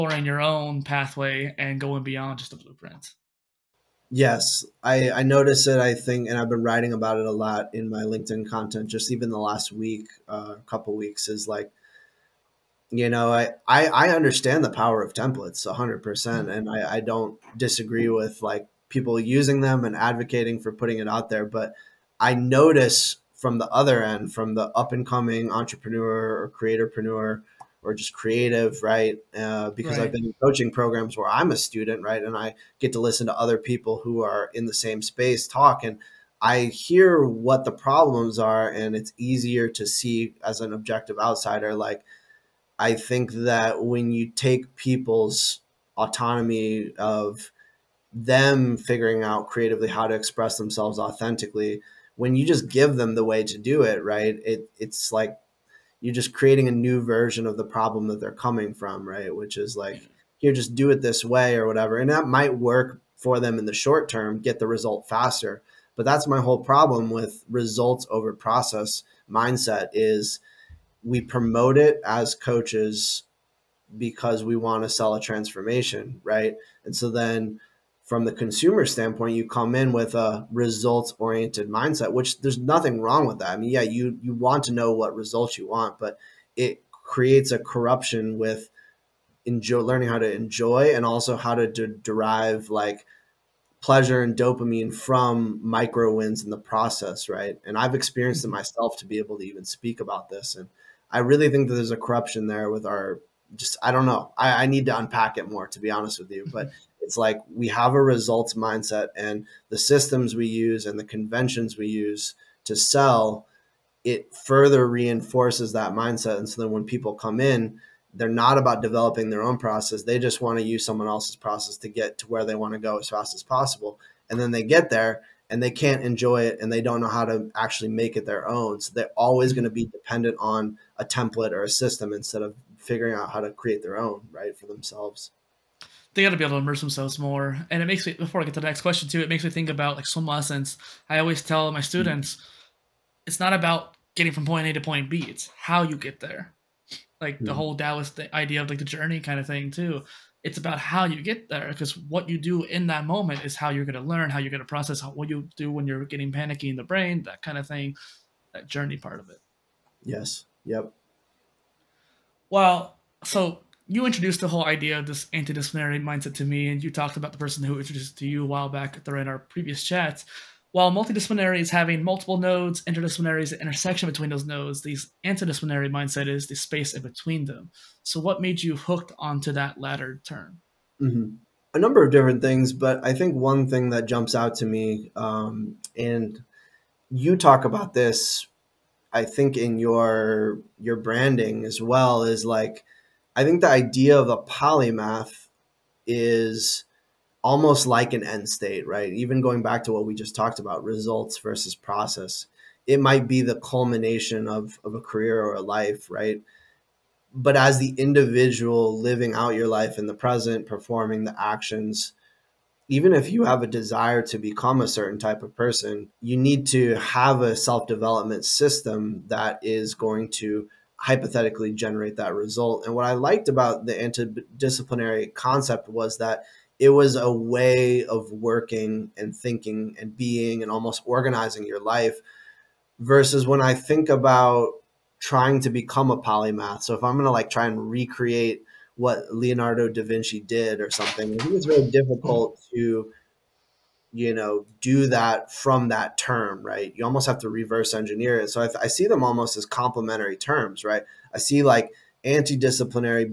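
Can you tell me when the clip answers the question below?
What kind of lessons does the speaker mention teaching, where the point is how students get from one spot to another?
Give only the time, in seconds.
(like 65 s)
140 s.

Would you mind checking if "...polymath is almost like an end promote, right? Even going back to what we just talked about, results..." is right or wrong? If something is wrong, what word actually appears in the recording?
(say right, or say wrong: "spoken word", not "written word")
wrong: "state", not "promote".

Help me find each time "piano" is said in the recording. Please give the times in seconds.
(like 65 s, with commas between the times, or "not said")
not said.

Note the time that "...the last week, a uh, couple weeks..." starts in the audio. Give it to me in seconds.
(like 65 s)
9 s.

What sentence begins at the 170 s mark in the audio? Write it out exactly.
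While multidisciplinary is having multiple nodes, interdisciplinary is the intersection between those nodes.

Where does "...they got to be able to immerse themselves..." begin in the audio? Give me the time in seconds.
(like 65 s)
136 s.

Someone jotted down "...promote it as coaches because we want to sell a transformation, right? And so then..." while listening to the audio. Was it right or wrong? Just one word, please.
right.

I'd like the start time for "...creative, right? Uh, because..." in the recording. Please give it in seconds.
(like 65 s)
28 s.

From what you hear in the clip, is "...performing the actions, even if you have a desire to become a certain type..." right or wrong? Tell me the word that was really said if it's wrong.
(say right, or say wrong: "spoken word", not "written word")
right.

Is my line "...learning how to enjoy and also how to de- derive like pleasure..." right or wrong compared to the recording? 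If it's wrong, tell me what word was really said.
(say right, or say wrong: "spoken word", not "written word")
right.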